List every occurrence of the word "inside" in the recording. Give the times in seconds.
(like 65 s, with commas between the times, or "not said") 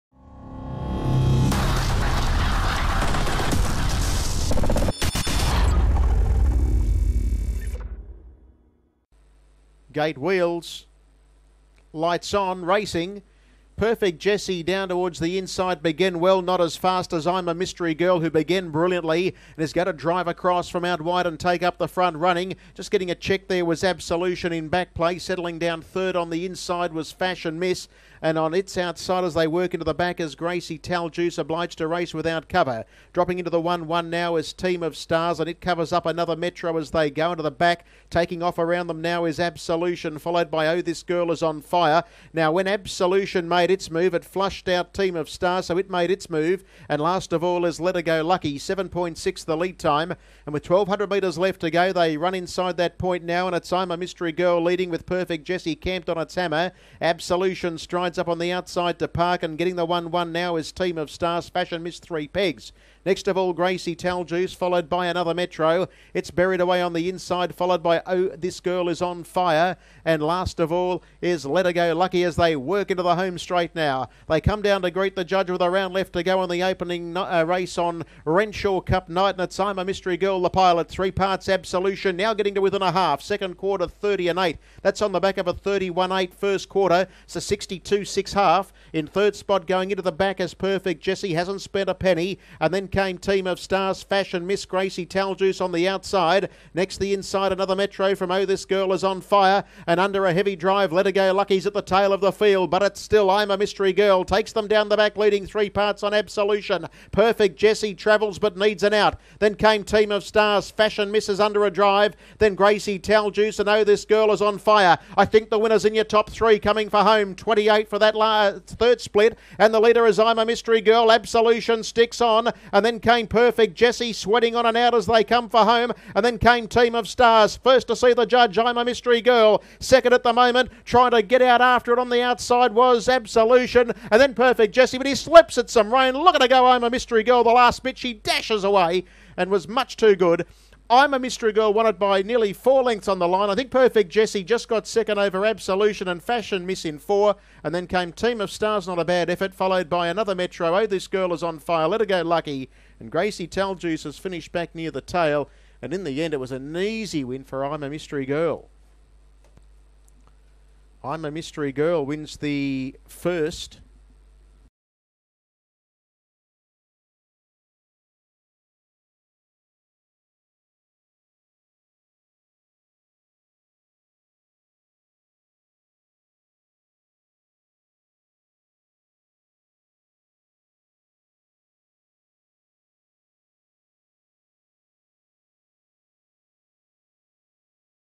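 15 s, 26 s, 52 s, 67 s, 97 s.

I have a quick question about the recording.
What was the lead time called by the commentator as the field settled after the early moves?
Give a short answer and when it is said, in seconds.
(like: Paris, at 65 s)
7.6, at 48 s.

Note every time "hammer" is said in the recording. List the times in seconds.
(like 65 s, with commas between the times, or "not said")
56 s.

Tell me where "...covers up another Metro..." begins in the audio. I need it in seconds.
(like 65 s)
35 s.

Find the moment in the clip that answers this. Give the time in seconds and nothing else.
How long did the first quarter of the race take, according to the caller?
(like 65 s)
85 s.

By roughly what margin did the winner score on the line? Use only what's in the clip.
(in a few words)
Nearly four lengths.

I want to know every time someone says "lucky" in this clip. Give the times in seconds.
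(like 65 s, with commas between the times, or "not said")
48 s, 71 s, 101 s, 152 s.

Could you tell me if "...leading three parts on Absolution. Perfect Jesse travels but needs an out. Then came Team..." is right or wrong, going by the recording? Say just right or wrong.
right.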